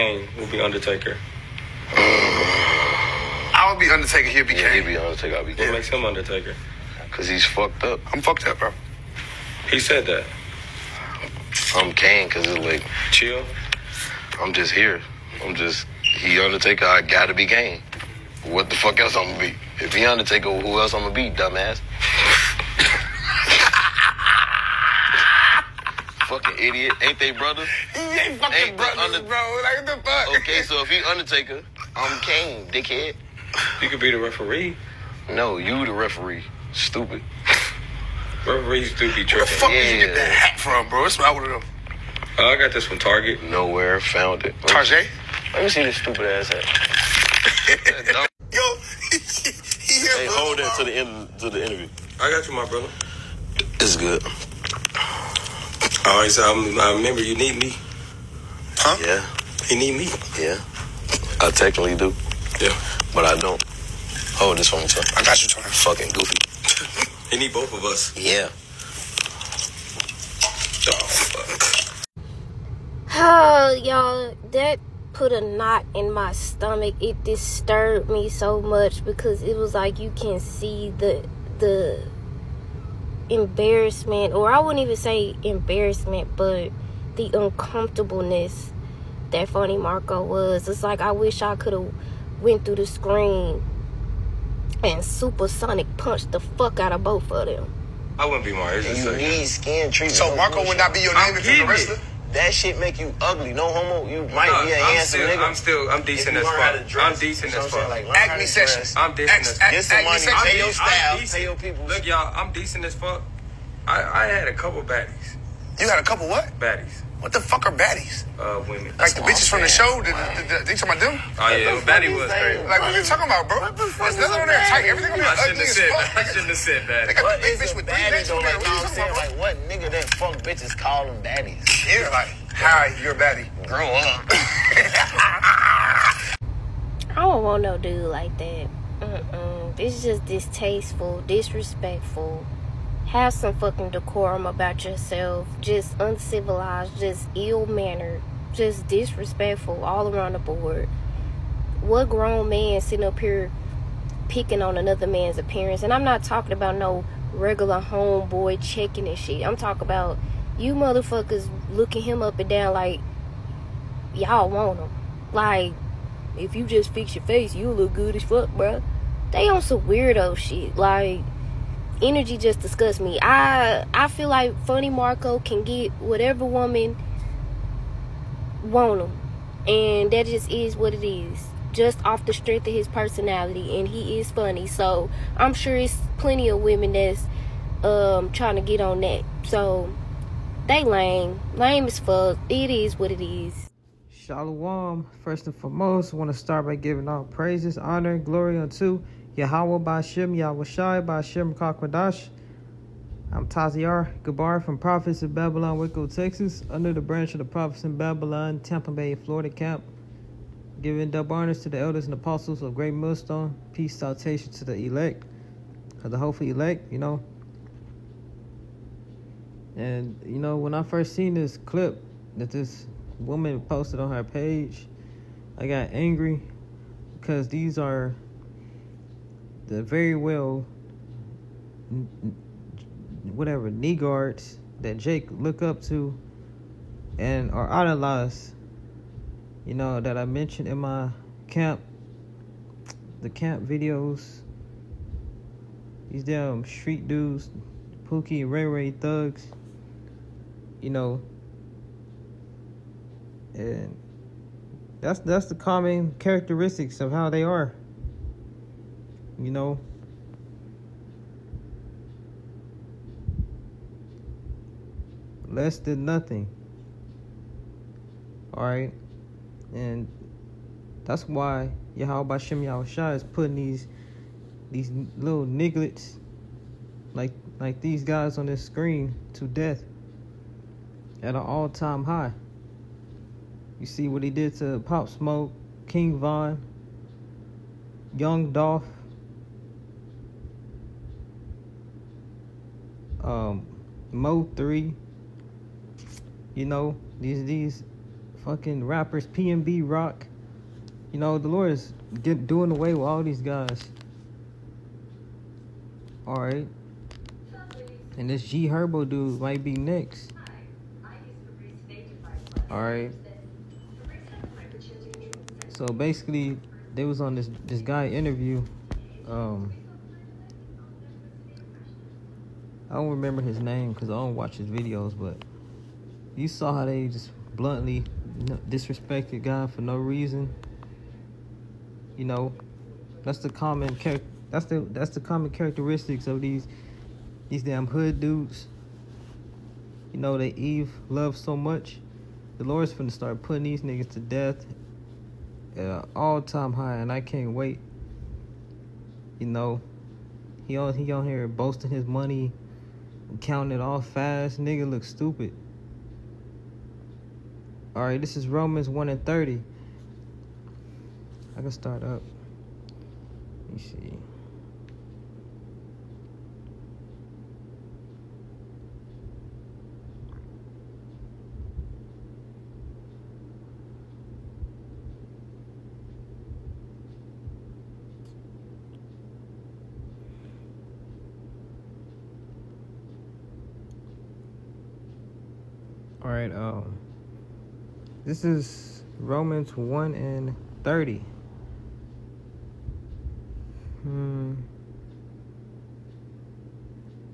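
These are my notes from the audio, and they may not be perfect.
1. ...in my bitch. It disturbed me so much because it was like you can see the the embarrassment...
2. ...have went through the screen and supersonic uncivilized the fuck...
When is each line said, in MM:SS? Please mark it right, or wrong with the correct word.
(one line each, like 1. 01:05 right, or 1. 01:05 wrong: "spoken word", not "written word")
1. 01:15 wrong: "stomach", not "bitch"
2. 01:31 wrong: "punched", not "uncivilized".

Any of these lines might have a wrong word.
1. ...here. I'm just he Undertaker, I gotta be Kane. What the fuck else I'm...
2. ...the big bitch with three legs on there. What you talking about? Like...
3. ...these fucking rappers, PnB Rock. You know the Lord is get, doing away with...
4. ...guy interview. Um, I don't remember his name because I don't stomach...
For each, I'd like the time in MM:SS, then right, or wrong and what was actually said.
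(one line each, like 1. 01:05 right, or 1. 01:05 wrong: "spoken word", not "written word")
1. 00:14 right
2. 02:07 right
3. 04:57 right
4. 05:17 wrong: "watch", not "stomach".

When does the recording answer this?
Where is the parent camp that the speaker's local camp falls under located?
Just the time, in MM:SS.
03:28.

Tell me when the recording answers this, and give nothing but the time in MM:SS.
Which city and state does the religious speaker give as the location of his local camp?
03:25.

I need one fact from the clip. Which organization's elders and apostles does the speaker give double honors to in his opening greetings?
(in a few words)
Great Millstone.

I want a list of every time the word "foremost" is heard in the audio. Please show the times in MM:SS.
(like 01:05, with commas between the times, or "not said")
03:15.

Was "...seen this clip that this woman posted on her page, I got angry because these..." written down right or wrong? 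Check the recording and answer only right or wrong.
right.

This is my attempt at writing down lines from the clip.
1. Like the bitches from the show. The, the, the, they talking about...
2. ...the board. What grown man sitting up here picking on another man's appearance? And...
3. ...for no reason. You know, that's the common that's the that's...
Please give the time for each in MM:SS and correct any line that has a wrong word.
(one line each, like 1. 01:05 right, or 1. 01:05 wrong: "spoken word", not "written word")
1. 01:58 right
2. 02:30 right
3. 05:29 right.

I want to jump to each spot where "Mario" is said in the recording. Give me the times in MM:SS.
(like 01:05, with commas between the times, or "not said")
01:38.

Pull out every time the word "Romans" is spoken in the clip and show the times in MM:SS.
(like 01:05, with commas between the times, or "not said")
05:58, 06:29.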